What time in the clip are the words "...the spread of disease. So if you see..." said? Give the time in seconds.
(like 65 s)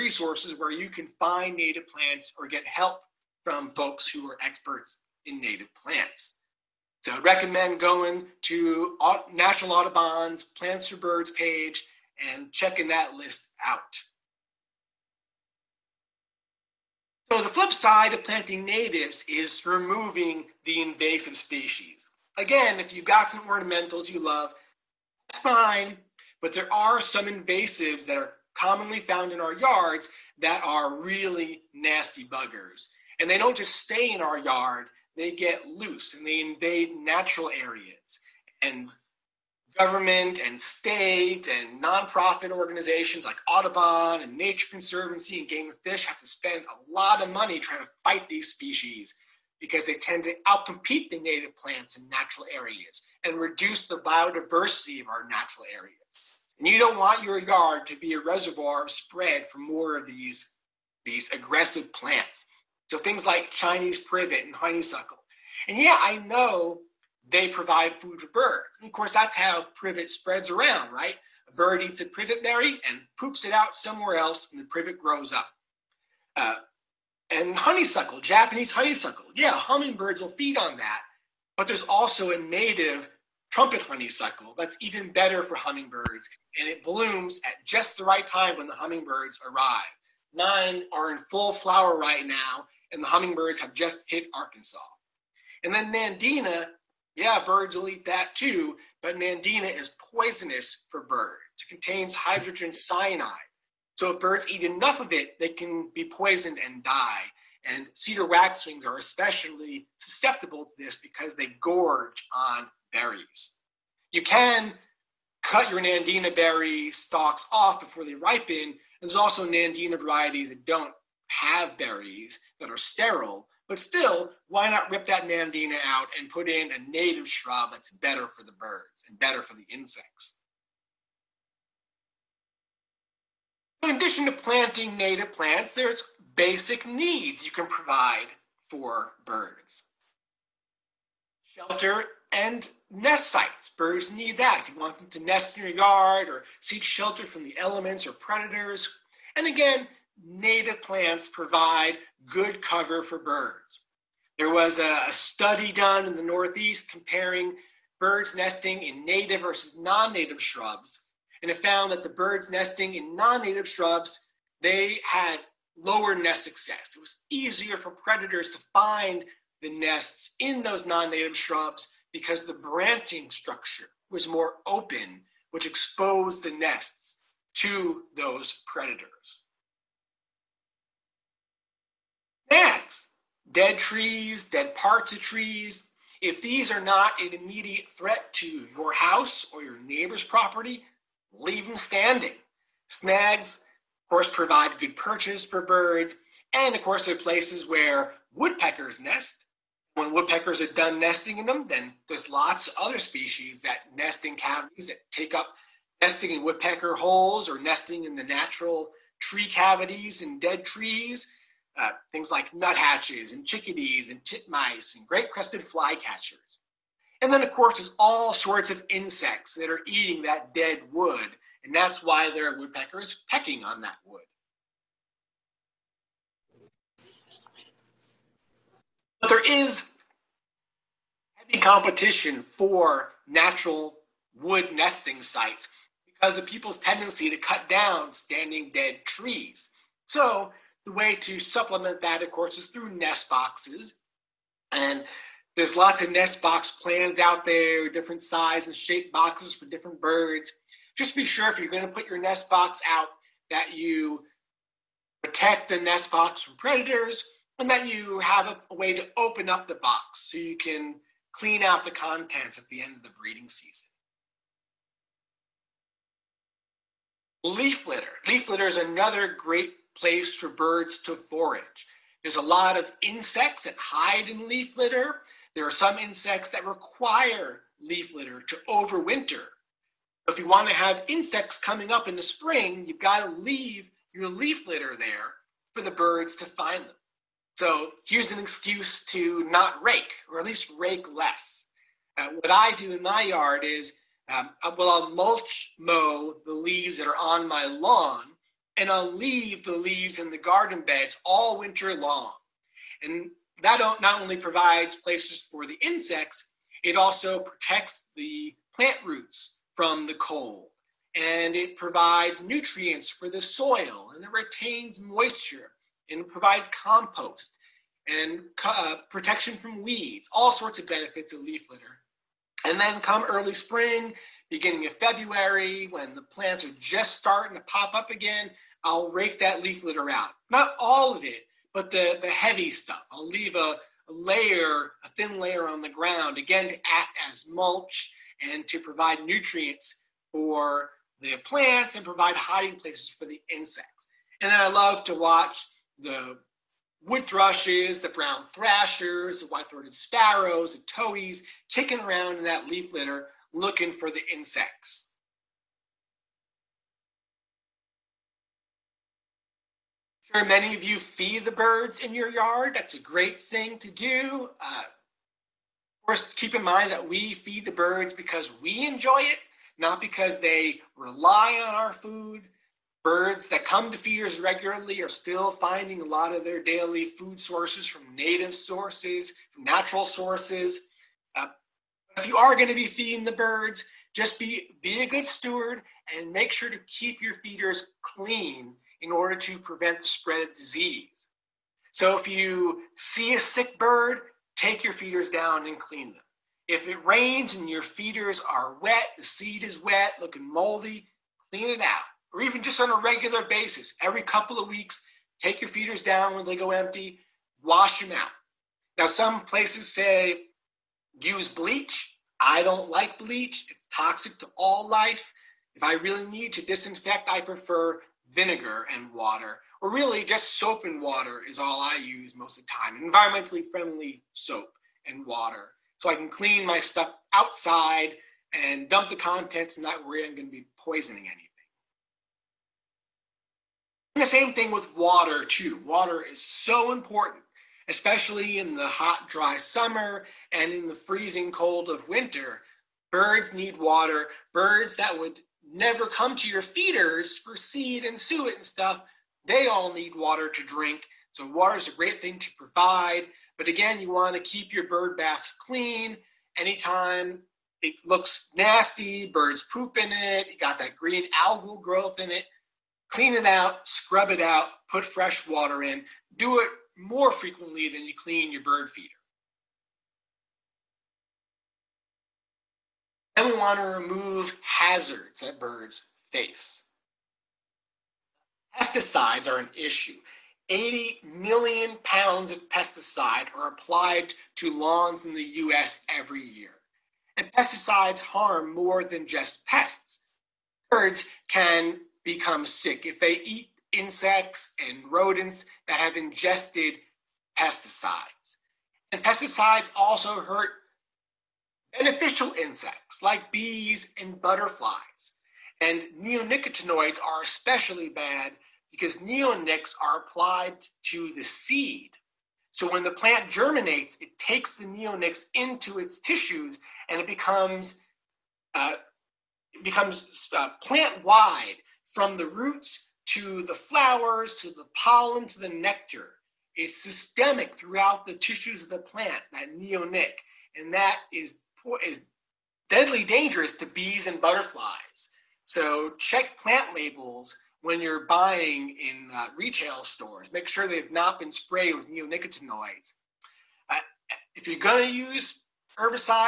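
389 s.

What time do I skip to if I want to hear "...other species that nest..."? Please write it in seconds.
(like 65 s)
202 s.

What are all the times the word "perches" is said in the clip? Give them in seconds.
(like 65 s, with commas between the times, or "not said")
194 s.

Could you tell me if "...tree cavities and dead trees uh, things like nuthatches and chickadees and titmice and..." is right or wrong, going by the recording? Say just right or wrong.
right.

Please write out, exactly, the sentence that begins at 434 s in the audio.
And the same thing with water, too.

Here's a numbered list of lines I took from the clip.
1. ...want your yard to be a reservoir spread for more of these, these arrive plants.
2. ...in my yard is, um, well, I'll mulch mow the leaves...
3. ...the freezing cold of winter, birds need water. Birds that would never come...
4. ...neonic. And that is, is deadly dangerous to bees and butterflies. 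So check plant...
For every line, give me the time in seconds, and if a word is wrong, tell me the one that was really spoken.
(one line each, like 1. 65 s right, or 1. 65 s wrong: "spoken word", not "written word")
1. 56 s wrong: "aggressive", not "arrive"
2. 292 s right
3. 440 s right
4. 529 s right.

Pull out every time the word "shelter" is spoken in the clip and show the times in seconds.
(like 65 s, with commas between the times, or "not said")
141 s, 146 s.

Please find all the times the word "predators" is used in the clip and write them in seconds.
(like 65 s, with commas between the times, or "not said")
148 s, 167 s, 178 s, 256 s.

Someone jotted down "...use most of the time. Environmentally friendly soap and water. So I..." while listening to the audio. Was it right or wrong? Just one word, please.
right.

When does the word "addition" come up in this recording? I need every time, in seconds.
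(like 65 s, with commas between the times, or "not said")
133 s.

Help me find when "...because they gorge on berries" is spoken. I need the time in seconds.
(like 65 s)
110 s.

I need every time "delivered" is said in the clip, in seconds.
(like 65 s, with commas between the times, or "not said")
not said.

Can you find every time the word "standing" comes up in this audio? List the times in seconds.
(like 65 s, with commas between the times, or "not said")
191 s, 238 s.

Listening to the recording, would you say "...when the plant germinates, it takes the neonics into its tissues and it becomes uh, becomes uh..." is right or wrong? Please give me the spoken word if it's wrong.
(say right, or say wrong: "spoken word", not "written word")
right.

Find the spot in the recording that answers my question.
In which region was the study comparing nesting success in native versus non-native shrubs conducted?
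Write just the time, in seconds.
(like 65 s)
156 s.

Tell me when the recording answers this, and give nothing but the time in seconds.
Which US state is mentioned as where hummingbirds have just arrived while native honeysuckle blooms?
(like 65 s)
94 s.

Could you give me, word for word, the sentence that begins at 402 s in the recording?
Or even just on a regular basis, every couple of weeks, take your feeders down when they go empty, wash them out.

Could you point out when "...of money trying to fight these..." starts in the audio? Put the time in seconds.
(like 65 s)
47 s.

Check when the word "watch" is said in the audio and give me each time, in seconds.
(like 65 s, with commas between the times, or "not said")
345 s.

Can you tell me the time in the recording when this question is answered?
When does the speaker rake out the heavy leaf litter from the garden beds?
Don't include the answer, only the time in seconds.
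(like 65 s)
324 s.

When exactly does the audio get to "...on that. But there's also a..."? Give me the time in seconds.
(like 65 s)
80 s.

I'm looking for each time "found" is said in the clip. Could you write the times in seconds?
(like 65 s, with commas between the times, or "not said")
29 s, 161 s.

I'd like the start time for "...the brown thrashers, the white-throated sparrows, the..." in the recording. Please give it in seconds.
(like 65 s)
347 s.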